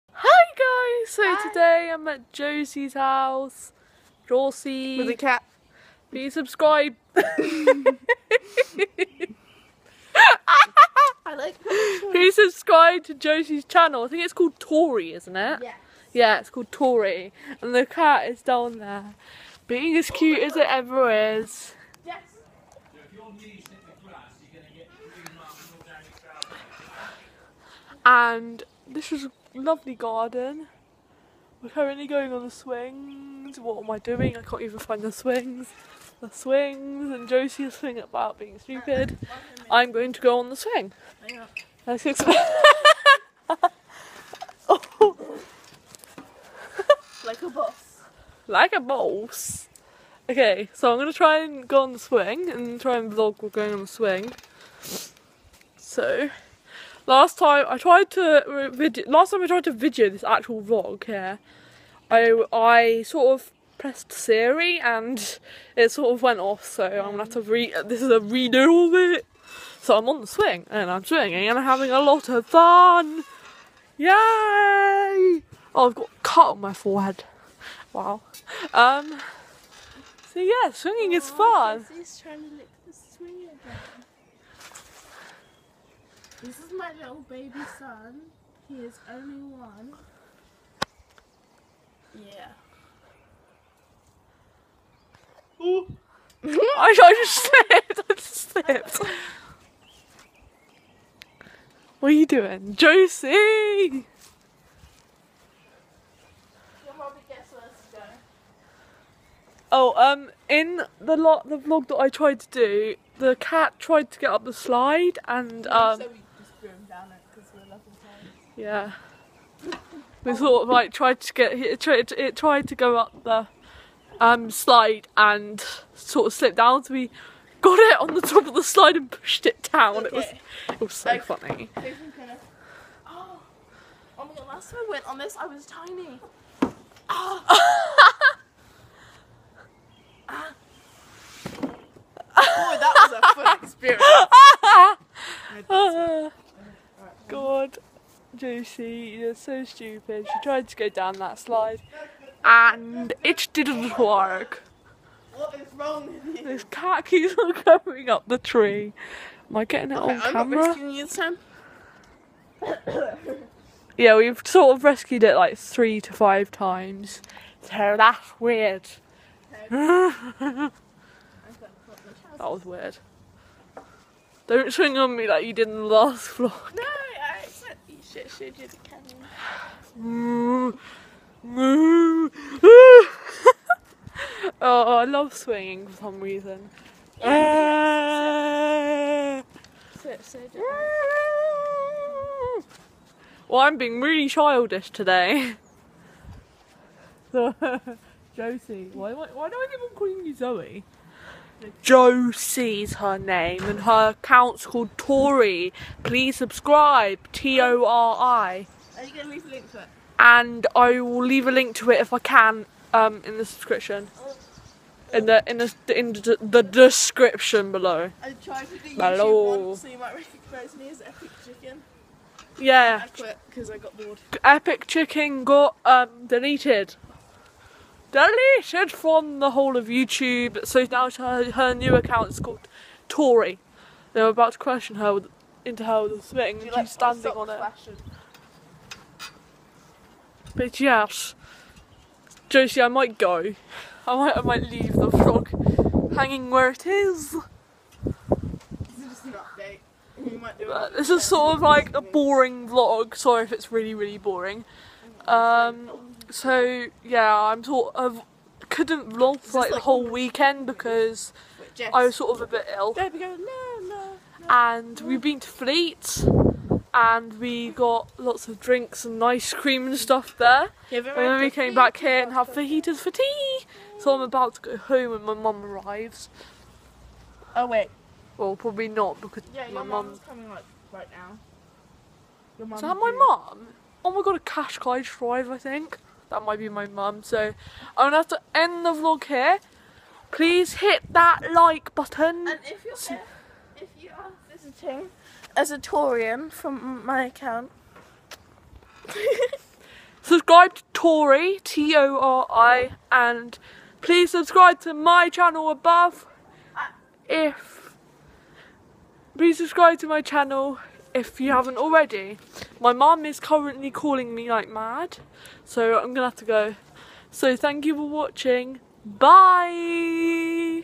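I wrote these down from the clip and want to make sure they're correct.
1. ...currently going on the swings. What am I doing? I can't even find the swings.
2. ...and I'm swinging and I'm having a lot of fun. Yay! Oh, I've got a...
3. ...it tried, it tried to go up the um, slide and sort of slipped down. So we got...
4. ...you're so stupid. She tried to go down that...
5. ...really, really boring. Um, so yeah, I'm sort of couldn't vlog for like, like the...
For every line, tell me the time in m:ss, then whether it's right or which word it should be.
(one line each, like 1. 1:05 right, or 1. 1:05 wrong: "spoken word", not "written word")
1. 0:31 right
2. 1:10 right
3. 2:01 right
4. 2:29 right
5. 4:13 right.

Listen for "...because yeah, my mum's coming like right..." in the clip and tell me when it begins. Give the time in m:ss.
4:39.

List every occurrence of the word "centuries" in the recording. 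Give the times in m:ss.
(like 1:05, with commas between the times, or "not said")
not said.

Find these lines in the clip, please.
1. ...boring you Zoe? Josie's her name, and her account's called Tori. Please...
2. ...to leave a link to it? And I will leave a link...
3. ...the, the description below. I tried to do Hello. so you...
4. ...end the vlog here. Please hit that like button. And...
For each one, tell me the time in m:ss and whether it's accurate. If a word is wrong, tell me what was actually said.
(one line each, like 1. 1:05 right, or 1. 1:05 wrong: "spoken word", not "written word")
1. 3:19 wrong: "calling", not "boring"
2. 3:29 right
3. 3:36 right
4. 4:48 right.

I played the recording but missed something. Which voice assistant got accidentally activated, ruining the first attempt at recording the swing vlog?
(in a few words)
Siri.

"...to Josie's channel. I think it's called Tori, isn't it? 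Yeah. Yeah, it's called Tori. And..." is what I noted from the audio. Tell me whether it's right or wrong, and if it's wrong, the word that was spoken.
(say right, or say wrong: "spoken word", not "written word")
right.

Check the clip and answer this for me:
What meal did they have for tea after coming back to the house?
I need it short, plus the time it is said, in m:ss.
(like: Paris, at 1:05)
fajitas, at 4:32.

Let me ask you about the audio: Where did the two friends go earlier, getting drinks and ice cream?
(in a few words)
Fleet.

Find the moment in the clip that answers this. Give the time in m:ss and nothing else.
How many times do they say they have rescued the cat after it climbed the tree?
2:45.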